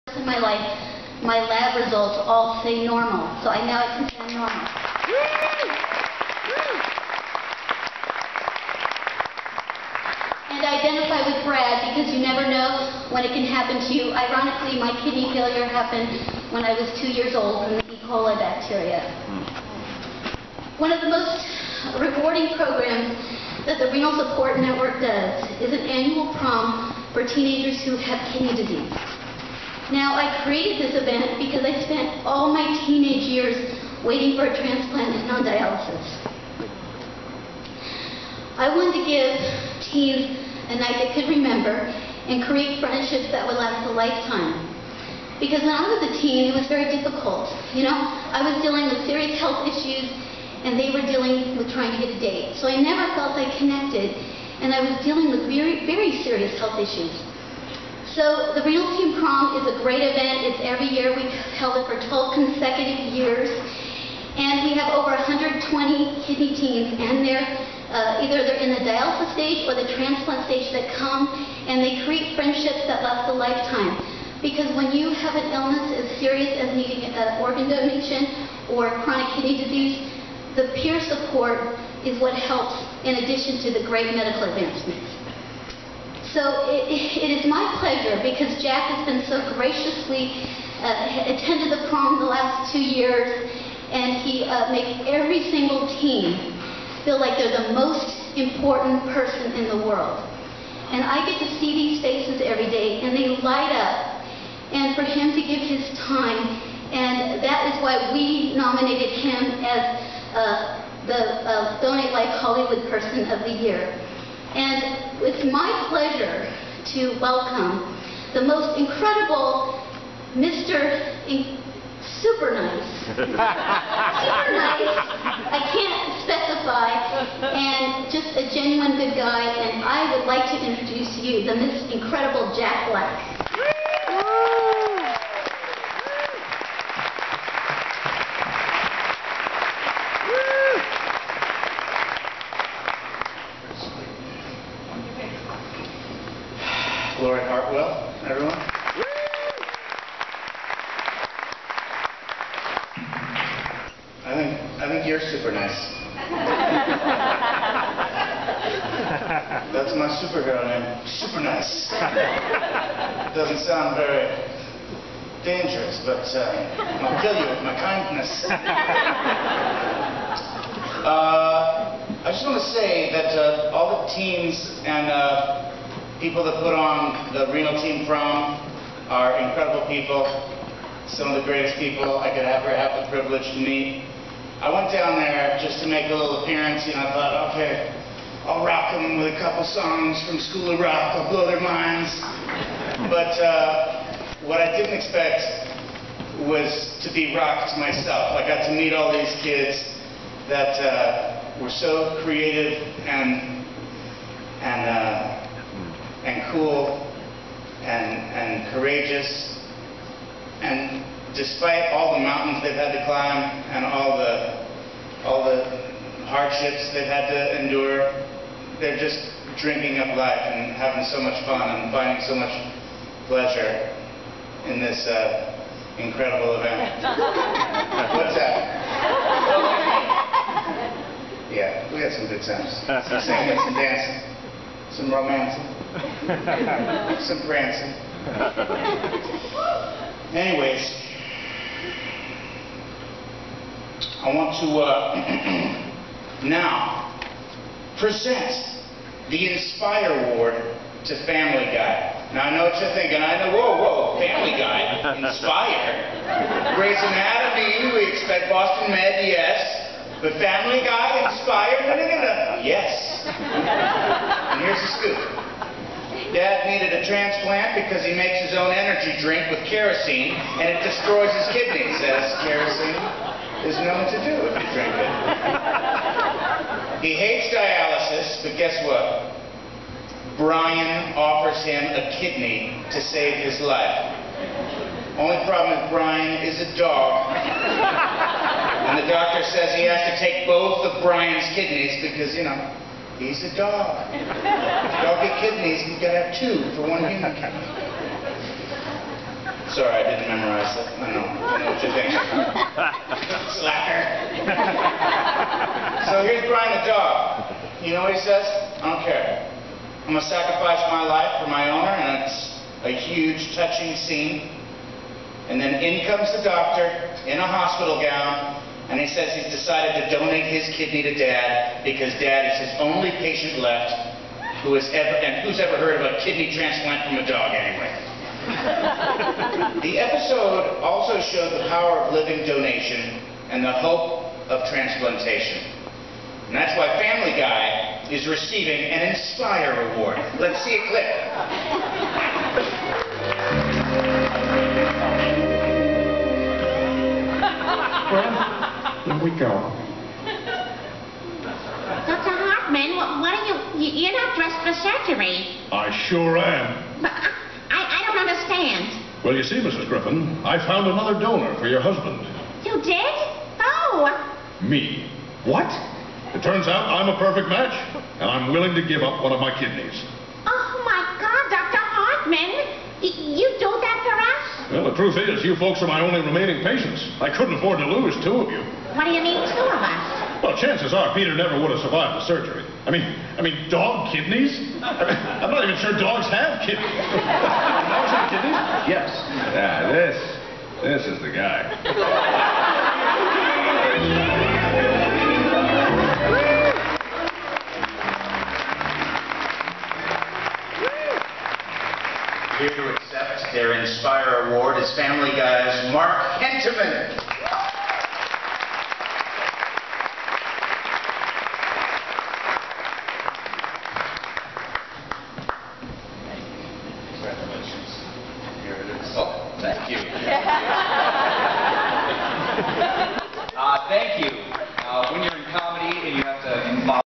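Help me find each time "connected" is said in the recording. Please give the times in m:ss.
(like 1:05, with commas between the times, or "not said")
0:53.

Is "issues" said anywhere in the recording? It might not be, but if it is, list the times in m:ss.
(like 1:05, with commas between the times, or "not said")
0:49, 0:56.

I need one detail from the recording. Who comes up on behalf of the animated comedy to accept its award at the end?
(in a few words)
Mark Hentemann.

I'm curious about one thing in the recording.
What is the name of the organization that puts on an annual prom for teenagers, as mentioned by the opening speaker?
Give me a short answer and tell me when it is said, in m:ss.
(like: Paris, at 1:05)
Renal Support Network, at 0:23.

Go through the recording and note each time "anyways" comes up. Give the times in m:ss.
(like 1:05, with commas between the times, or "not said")
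4:00, 5:27.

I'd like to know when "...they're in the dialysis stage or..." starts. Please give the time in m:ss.
1:08.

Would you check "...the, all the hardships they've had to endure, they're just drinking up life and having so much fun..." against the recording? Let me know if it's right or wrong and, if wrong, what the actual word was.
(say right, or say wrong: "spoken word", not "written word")
right.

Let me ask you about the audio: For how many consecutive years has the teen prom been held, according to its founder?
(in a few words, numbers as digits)
12.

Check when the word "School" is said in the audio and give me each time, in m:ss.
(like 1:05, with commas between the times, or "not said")
3:10.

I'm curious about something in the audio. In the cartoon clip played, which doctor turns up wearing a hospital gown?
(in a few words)
Dr. Hartman.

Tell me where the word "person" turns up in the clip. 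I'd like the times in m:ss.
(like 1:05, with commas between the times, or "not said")
1:39, 1:52.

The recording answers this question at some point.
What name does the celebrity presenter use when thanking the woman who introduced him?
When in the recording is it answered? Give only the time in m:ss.
2:27.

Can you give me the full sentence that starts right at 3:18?
I got to meet all these kids that uh, were so creative and, and uh, and cool and, and courageous.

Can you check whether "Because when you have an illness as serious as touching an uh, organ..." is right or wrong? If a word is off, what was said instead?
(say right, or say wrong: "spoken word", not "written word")
wrong: "needing", not "touching".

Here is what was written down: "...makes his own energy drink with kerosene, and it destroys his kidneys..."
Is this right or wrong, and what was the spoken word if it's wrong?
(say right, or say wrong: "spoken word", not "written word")
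right.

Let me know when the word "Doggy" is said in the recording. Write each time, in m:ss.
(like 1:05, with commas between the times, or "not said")
4:54.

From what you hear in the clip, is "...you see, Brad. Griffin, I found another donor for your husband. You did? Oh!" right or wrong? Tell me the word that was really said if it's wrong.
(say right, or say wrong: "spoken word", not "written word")
wrong: "Mrs", not "Brad".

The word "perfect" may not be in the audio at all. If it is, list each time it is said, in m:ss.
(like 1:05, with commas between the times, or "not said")
6:07.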